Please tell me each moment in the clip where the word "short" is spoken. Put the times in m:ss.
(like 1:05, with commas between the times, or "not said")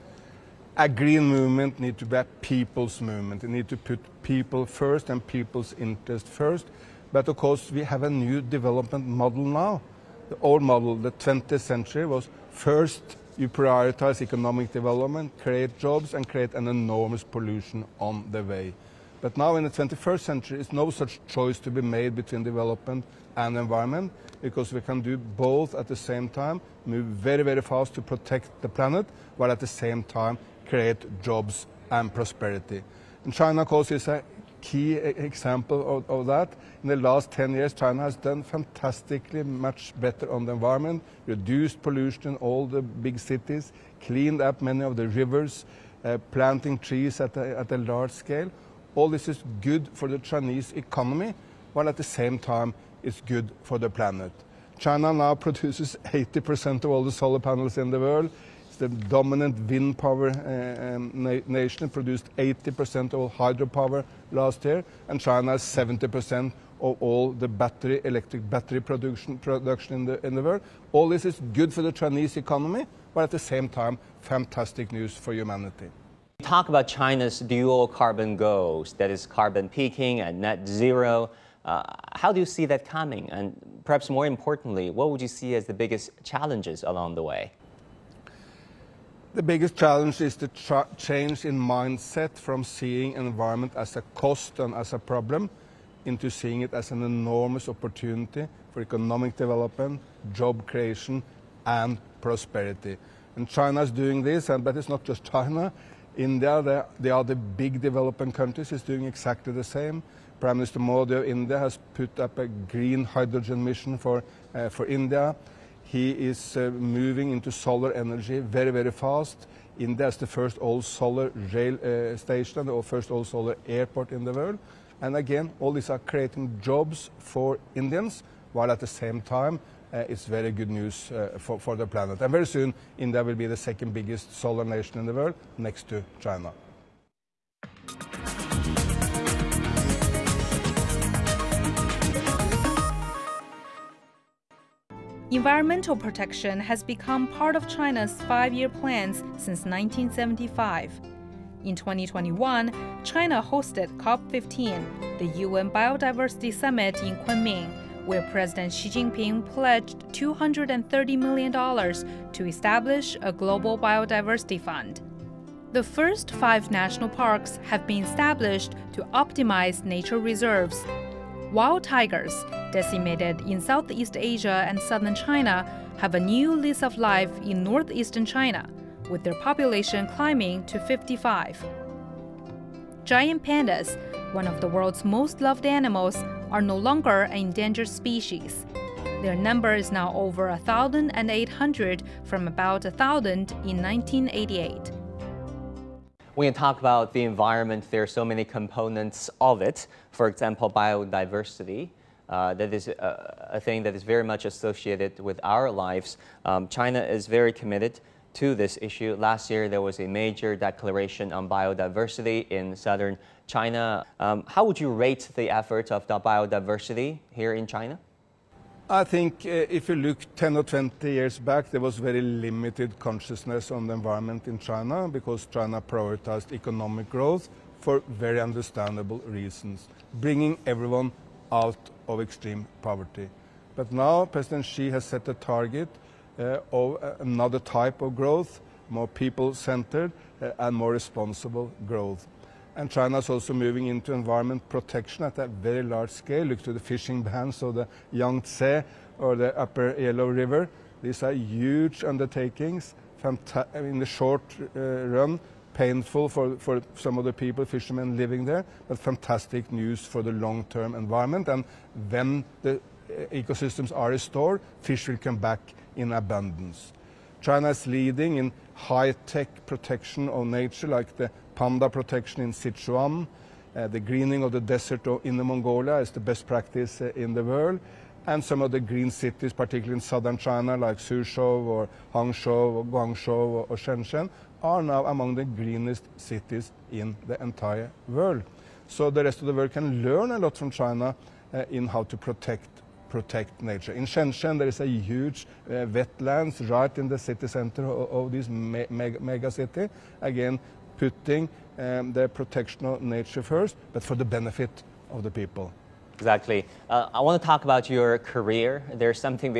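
4:14.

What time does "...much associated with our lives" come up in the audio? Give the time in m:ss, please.
3:24.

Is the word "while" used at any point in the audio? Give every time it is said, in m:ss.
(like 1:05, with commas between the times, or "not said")
0:29, 0:51, 2:08.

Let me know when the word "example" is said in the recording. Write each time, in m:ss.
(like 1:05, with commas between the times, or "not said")
0:34, 3:20.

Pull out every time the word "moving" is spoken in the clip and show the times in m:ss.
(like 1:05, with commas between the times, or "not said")
1:56, 4:03.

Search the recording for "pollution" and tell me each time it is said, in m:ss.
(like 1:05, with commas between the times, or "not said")
0:17, 0:41.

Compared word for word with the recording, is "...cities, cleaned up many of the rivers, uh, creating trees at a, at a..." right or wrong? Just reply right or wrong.
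wrong.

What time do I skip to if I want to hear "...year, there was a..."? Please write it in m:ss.
3:29.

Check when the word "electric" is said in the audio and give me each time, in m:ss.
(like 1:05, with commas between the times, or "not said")
1:08.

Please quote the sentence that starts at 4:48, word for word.
So the rest of the world can learn a lot from China uh, in how to protect protect nature.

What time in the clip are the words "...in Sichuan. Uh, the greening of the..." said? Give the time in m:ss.
4:32.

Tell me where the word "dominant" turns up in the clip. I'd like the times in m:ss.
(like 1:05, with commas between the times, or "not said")
0:58.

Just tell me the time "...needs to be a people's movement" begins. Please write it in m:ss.
0:01.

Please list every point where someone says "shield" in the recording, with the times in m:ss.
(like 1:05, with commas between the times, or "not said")
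not said.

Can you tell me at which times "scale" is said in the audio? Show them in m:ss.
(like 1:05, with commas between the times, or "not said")
0:48, 4:06.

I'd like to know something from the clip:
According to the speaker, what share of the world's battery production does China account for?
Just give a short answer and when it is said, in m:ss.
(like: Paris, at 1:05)
70%, at 1:05.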